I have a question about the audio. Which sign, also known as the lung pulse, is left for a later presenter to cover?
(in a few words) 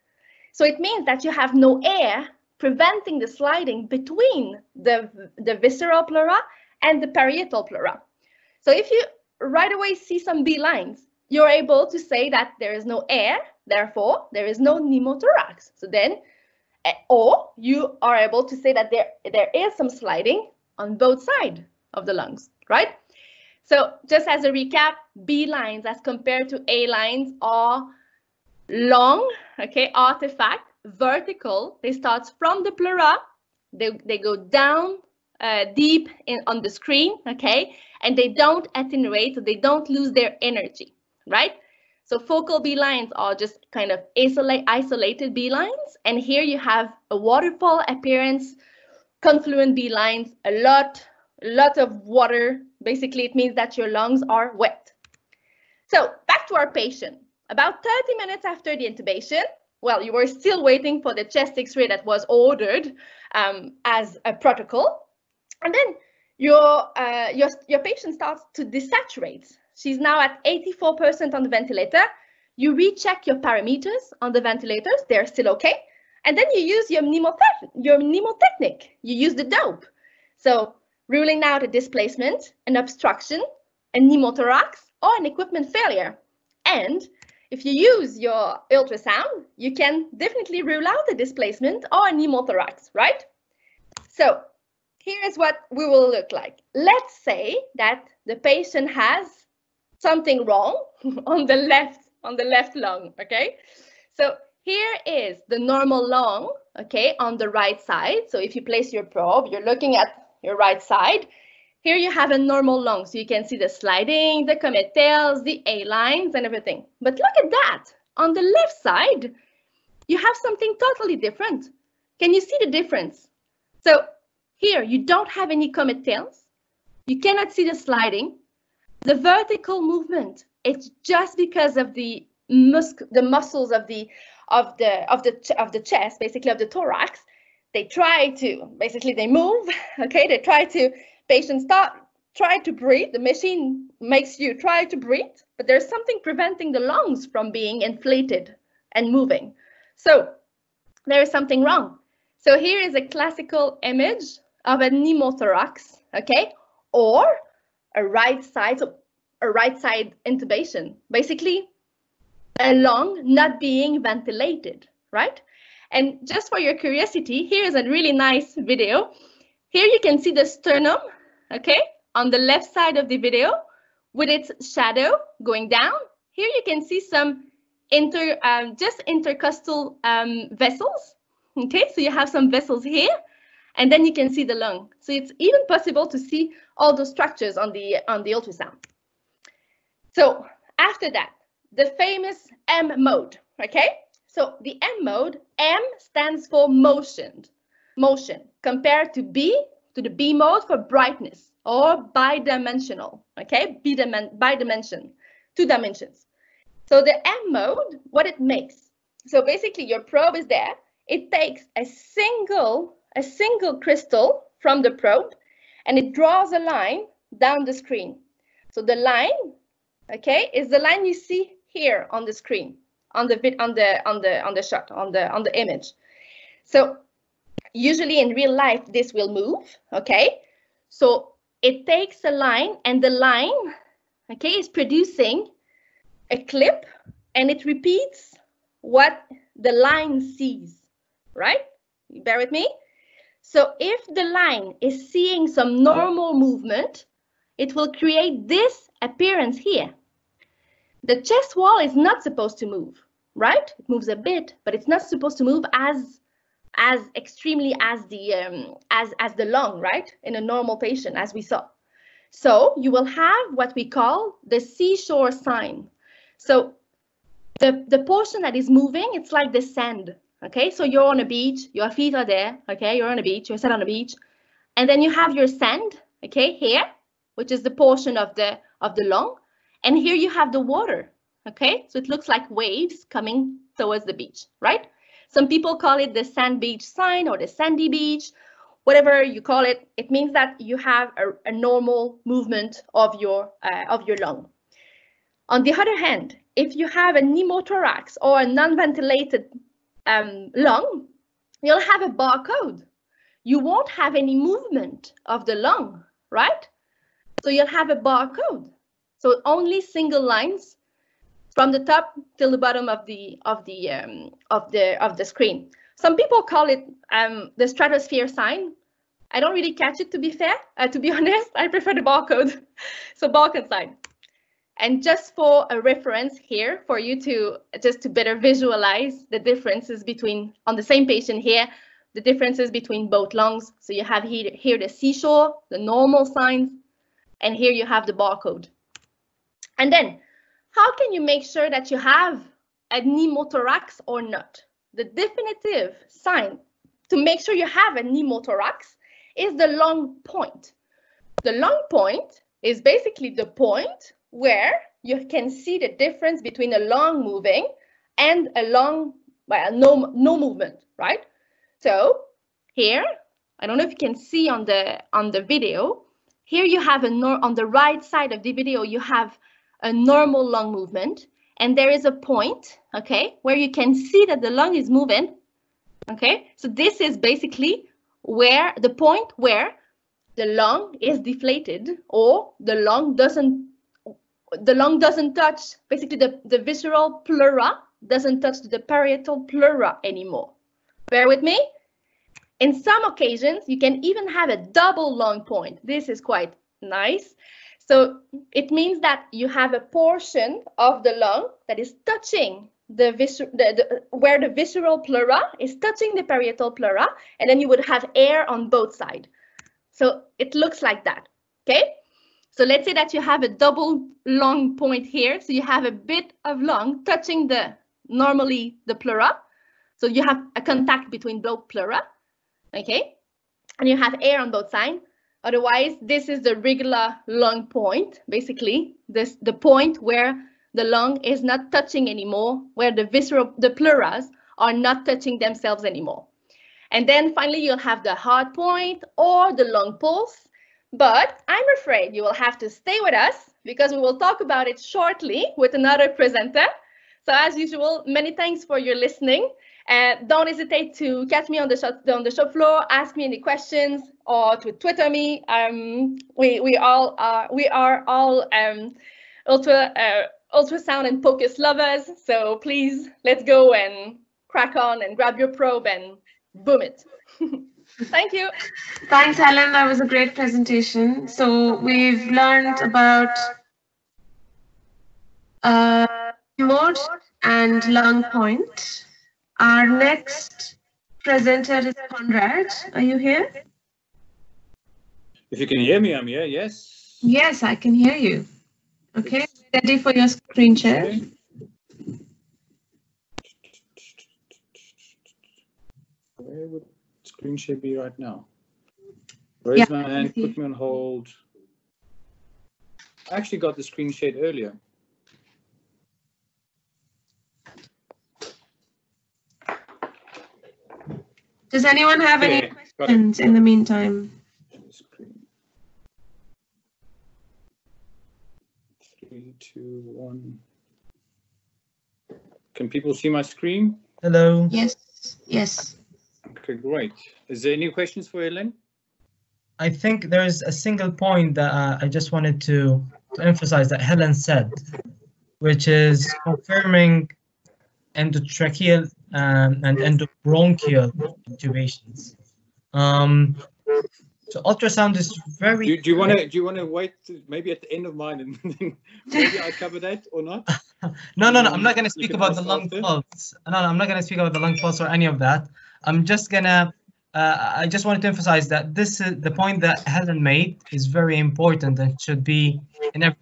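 Heart point.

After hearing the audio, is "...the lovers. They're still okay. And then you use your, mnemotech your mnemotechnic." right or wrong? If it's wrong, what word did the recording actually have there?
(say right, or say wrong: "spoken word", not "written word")
wrong: "ventilators", not "lovers".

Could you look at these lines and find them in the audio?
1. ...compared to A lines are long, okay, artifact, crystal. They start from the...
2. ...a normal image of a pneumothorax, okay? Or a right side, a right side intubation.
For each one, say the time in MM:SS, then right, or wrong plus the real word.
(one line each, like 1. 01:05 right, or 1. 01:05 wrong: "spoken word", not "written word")
1. 00:26 wrong: "vertical", not "crystal"
2. 02:32 wrong: "classical", not "normal".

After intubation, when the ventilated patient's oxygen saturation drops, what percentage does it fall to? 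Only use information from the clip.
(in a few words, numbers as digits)
84%.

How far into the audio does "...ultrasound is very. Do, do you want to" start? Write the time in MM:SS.
09:04.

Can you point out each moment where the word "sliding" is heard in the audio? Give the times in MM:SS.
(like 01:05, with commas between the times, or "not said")
00:03, 00:19, 01:53, 02:07.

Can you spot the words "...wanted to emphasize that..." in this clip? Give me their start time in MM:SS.
09:18.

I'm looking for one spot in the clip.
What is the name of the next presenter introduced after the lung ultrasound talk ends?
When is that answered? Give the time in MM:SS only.
08:02.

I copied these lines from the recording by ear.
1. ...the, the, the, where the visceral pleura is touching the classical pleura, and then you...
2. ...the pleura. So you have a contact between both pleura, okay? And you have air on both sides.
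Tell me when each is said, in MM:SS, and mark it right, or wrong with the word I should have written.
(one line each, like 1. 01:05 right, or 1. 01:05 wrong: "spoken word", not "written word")
1. 06:42 wrong: "parietal", not "classical"
2. 06:58 right.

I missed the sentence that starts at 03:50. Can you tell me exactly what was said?
So it takes a line and the line, okay, is producing a clip and it repeats what the line sees, right?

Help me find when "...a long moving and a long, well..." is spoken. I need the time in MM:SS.
05:56.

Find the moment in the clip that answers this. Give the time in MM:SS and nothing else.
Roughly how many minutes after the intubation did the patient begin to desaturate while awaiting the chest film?
00:57.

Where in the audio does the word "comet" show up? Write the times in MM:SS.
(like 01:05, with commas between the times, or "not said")
01:54, 02:05.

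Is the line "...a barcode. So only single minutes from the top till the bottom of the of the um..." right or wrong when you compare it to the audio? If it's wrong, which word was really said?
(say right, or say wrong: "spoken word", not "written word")
wrong: "lines", not "minutes".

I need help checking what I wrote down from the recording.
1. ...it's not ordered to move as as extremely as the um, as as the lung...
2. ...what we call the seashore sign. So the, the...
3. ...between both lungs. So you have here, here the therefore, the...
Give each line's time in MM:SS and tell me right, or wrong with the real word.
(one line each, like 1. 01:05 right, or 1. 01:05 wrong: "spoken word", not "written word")
1. 04:14 wrong: "supposed", not "ordered"
2. 04:23 right
3. 05:32 wrong: "seashore", not "therefore".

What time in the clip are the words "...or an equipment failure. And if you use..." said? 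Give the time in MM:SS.
01:25.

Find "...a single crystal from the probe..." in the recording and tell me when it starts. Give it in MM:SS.
03:33.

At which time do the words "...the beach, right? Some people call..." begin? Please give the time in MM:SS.
04:44.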